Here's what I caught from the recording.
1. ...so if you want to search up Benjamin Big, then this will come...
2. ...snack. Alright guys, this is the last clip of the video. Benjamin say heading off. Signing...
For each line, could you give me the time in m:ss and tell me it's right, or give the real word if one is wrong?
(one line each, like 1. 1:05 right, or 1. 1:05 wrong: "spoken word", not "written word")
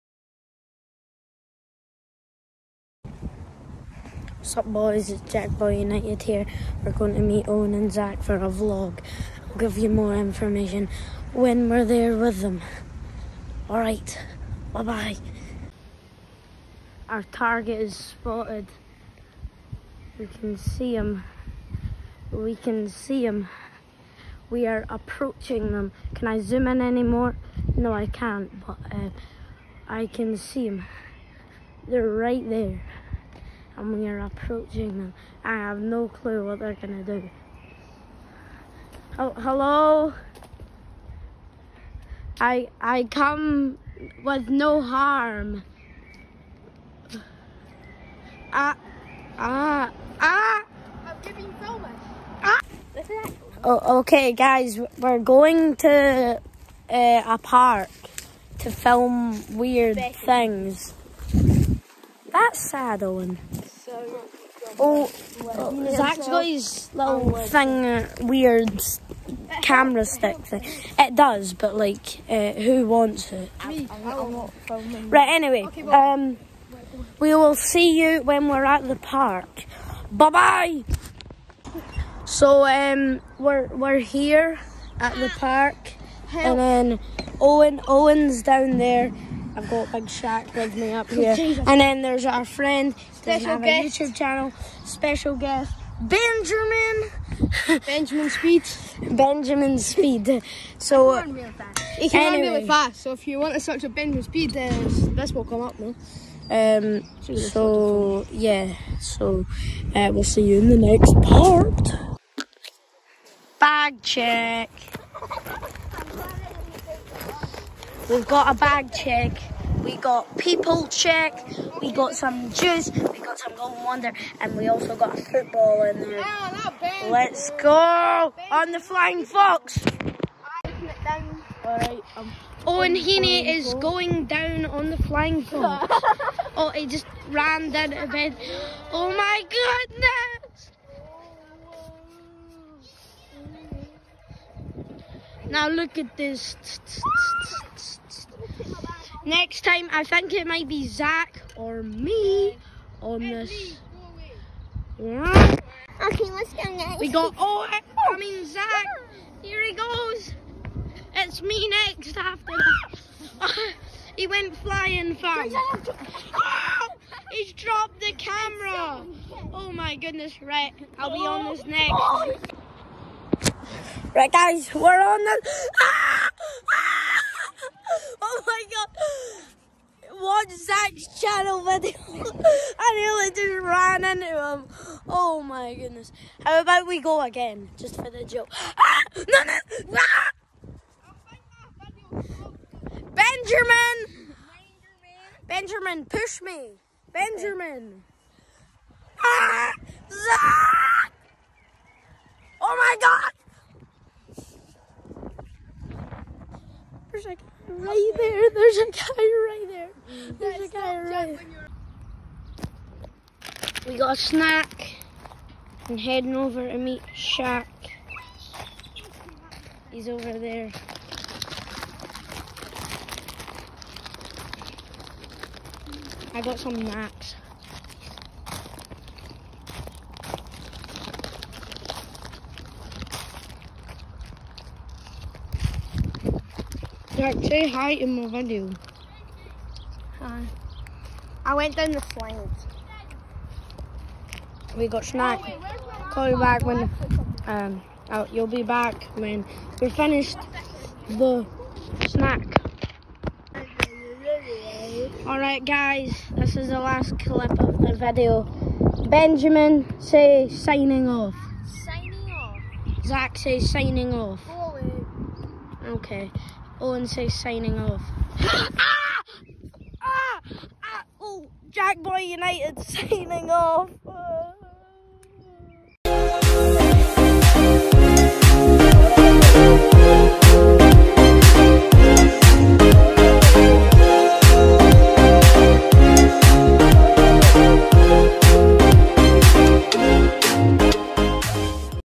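1. 1:43 wrong: "Speed", not "Big"
2. 4:12 wrong: "signing", not "heading".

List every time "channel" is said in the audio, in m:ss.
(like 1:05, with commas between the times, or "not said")
1:34, 3:01.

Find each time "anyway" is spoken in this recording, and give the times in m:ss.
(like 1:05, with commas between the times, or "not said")
1:15, 1:42.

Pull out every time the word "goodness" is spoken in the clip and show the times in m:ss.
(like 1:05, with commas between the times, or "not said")
2:19, 2:49, 3:05.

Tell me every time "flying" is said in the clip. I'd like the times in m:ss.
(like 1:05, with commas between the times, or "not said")
2:08, 2:15, 2:44.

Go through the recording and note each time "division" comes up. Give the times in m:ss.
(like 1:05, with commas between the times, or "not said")
not said.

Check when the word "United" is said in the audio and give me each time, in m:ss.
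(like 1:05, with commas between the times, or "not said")
0:05, 4:32.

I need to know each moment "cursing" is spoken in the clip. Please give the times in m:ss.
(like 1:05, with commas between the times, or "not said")
not said.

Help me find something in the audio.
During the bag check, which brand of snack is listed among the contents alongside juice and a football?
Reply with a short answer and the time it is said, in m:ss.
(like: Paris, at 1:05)
Golden Wonder, at 2:03.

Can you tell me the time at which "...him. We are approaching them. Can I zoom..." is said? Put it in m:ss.
0:23.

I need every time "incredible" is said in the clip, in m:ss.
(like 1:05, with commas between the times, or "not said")
not said.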